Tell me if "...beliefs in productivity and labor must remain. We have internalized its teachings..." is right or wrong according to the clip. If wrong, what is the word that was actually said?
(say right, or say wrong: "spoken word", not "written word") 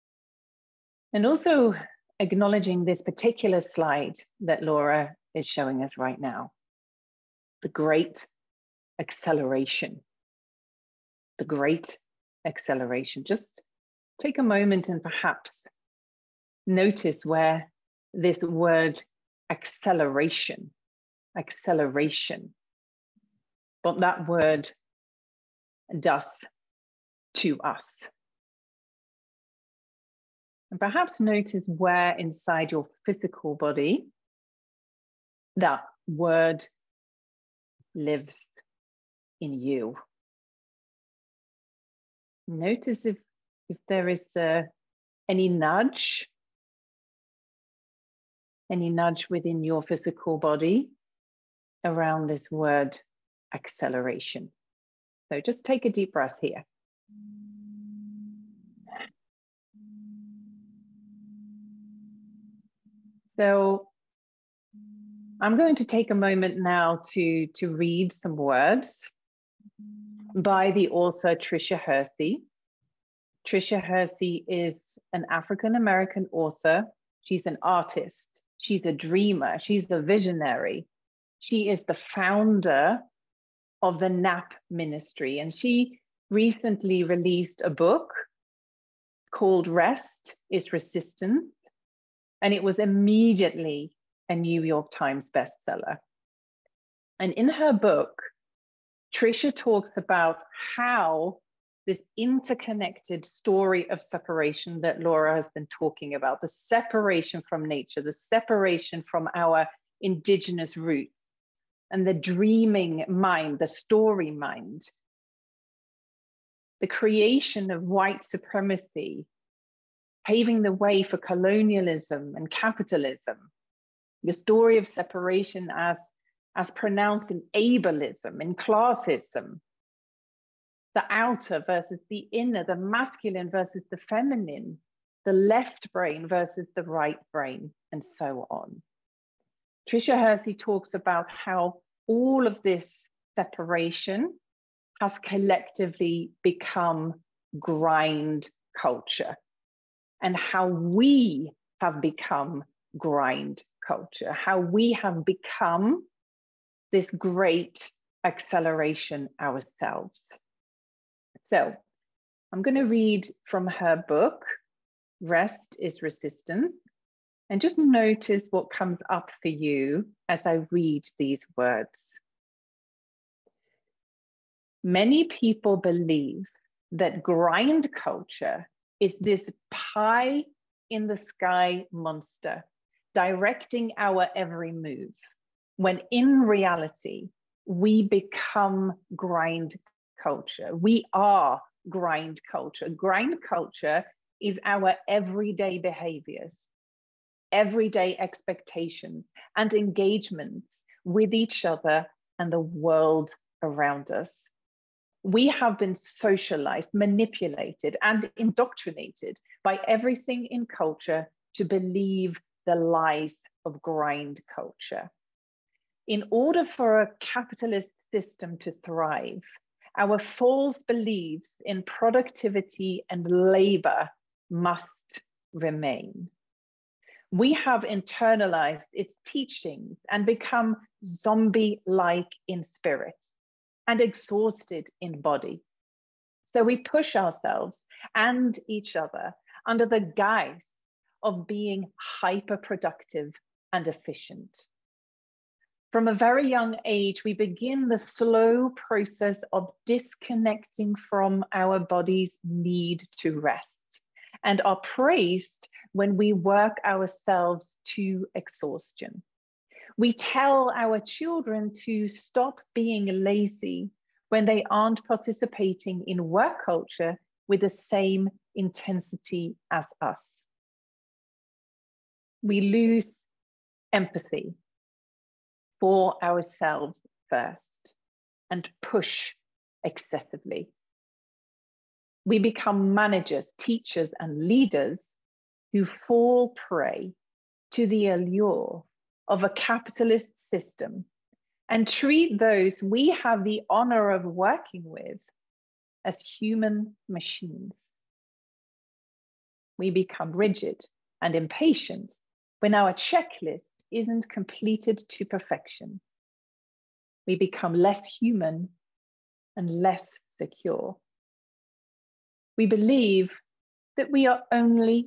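right.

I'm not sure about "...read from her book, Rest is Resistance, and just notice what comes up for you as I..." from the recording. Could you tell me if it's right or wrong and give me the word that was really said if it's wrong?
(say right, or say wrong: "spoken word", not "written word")
right.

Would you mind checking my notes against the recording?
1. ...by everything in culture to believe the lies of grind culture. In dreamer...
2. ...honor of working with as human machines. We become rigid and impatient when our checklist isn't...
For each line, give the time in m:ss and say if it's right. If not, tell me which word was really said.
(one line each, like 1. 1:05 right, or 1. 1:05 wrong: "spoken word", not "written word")
1. 3:29 wrong: "order", not "dreamer"
2. 4:53 right.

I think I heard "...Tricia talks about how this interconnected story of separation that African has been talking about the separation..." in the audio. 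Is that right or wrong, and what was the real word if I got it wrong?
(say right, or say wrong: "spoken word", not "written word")
wrong: "Laura", not "African".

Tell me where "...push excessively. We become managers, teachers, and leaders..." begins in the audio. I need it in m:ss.
4:38.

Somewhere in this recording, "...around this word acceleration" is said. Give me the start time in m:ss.
0:51.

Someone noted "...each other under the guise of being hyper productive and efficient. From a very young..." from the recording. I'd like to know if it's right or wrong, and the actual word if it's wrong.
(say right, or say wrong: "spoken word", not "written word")
right.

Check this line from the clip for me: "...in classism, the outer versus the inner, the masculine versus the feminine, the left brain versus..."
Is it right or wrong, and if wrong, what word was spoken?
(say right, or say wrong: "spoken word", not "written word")
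right.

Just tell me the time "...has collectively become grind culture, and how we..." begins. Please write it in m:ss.
2:25.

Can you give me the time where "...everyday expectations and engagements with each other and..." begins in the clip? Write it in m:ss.
3:17.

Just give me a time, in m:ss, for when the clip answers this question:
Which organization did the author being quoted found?
1:24.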